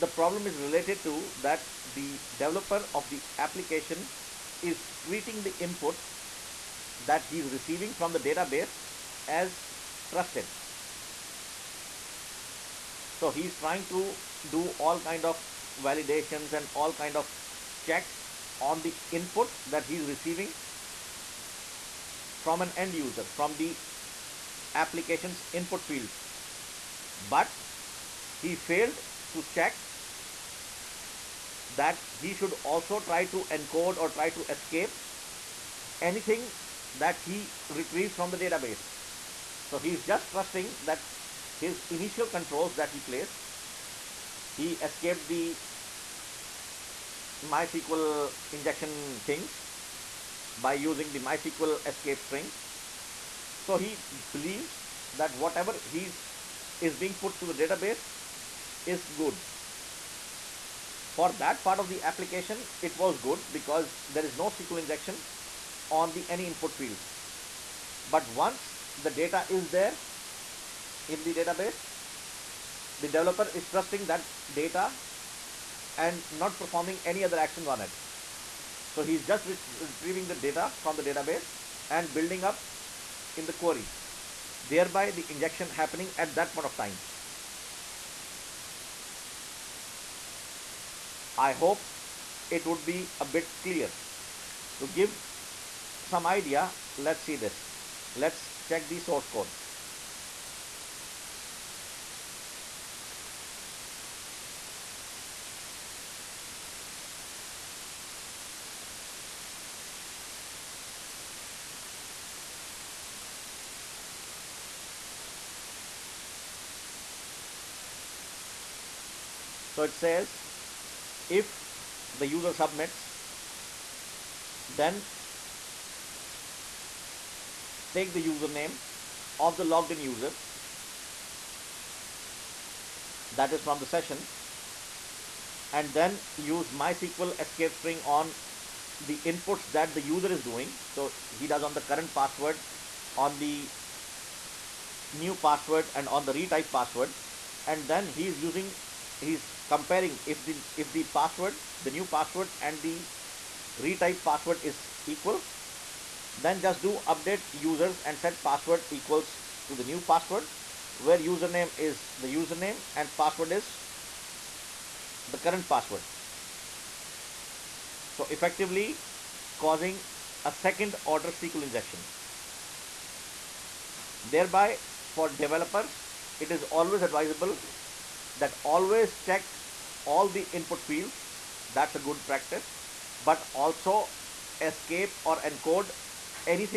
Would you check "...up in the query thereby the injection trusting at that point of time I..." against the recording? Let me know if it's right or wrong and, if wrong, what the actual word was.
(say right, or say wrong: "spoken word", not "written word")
wrong: "happening", not "trusting".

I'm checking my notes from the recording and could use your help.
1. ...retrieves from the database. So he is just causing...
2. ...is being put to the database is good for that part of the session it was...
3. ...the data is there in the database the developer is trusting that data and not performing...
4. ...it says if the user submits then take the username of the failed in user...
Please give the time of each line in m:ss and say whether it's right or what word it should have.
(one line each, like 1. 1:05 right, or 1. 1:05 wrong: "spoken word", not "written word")
1. 0:37 wrong: "trusting", not "causing"
2. 0:56 wrong: "application", not "session"
3. 1:09 right
4. 1:59 wrong: "logged", not "failed".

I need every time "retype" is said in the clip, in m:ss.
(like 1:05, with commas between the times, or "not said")
2:26, 2:33.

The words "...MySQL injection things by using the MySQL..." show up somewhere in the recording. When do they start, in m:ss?
0:47.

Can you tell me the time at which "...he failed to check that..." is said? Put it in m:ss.
0:28.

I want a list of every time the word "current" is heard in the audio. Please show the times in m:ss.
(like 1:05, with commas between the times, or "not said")
2:21, 2:45.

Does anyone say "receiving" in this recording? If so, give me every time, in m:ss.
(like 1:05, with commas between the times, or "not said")
0:07, 0:20.